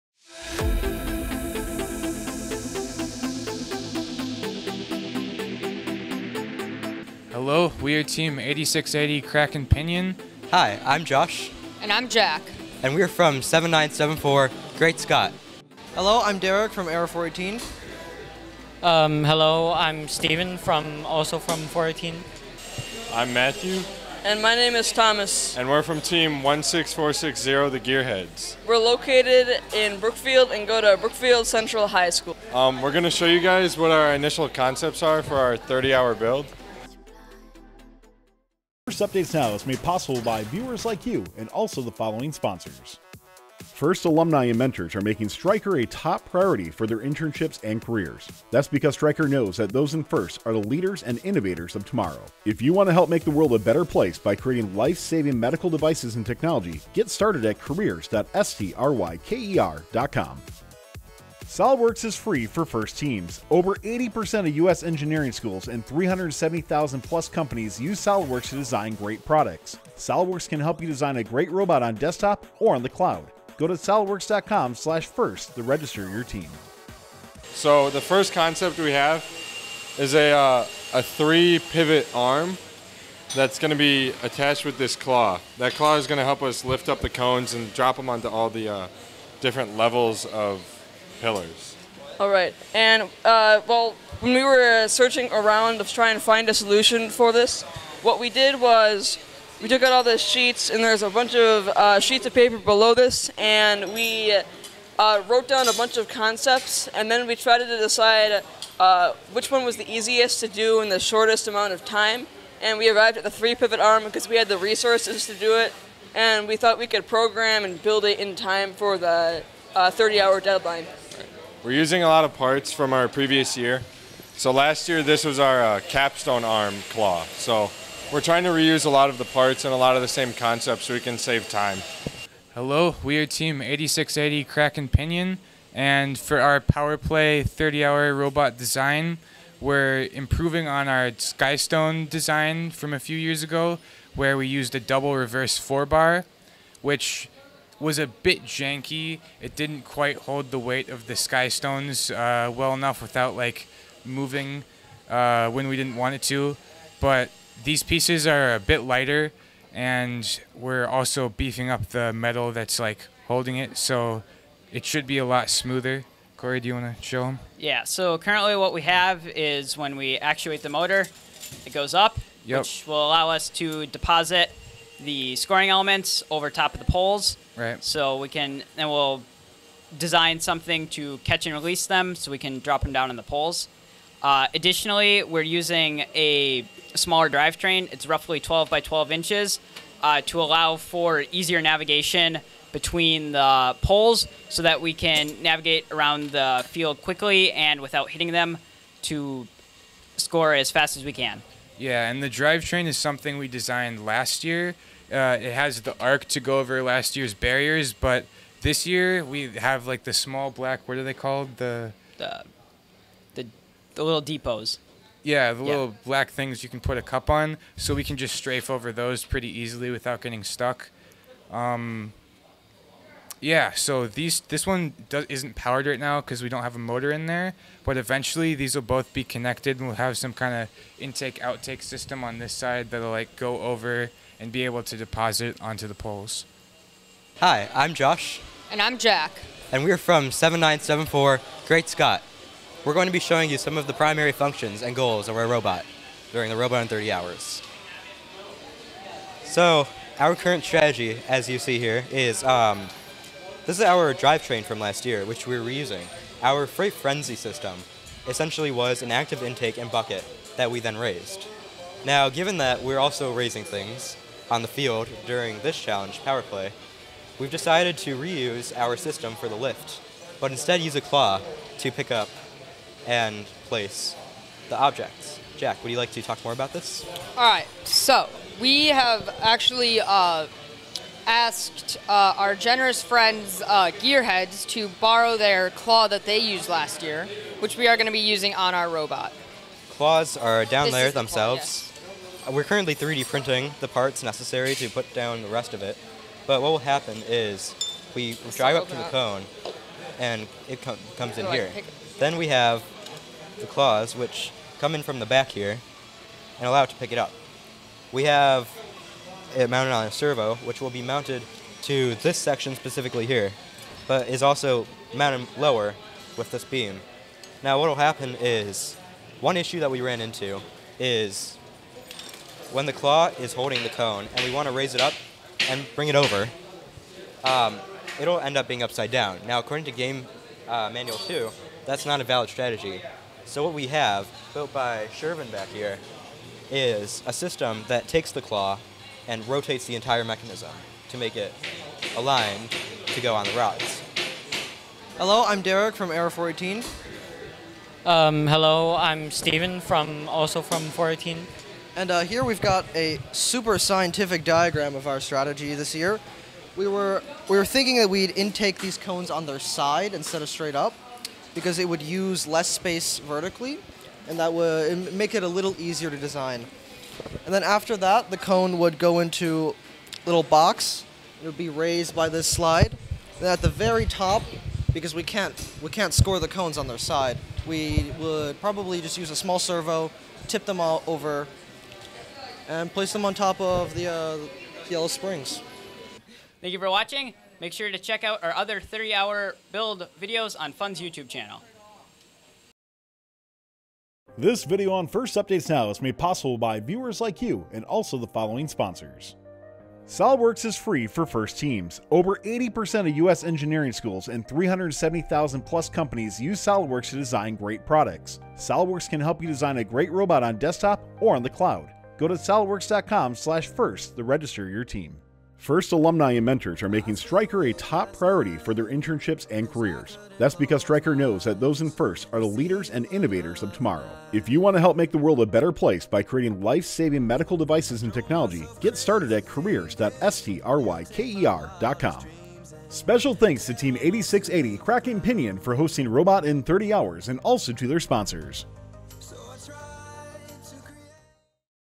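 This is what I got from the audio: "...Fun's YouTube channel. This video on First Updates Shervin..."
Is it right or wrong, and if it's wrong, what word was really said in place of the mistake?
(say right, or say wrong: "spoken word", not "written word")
wrong: "Now", not "Shervin".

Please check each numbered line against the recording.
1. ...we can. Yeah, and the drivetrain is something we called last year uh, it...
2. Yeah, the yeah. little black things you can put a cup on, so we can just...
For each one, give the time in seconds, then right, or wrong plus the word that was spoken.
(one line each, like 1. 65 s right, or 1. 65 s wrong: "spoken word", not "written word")
1. 201 s wrong: "designed", not "called"
2. 215 s right.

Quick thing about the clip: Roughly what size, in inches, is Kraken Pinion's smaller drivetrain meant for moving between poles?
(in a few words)
12 by 12 inches.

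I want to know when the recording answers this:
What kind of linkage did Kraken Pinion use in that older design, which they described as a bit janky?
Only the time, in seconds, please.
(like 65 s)
144 s.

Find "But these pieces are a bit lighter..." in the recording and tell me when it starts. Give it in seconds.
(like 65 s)
157 s.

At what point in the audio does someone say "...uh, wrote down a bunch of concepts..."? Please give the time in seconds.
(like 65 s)
104 s.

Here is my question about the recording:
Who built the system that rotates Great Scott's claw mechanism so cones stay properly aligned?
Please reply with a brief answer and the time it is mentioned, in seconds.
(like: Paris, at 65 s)
Shervin, at 335 s.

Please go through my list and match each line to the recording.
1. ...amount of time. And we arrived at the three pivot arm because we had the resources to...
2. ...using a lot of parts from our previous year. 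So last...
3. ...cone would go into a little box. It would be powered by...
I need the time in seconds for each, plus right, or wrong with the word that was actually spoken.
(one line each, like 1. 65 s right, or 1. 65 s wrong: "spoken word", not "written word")
1. 111 s right
2. 121 s right
3. 368 s wrong: "raised", not "powered".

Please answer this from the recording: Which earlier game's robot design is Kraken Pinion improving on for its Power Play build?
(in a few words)
Skystone.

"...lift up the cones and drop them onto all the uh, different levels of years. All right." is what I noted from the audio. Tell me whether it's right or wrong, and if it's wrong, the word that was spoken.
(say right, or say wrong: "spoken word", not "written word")
wrong: "pillars", not "years".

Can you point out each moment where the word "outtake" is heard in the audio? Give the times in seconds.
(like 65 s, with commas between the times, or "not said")
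231 s.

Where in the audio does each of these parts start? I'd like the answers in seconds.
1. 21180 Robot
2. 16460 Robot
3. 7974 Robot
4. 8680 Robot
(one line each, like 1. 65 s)
1. 344 s
2. 77 s
3. 237 s
4. 132 s.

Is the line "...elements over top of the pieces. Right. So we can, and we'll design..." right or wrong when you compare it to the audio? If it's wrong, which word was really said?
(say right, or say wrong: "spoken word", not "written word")
wrong: "poles", not "pieces".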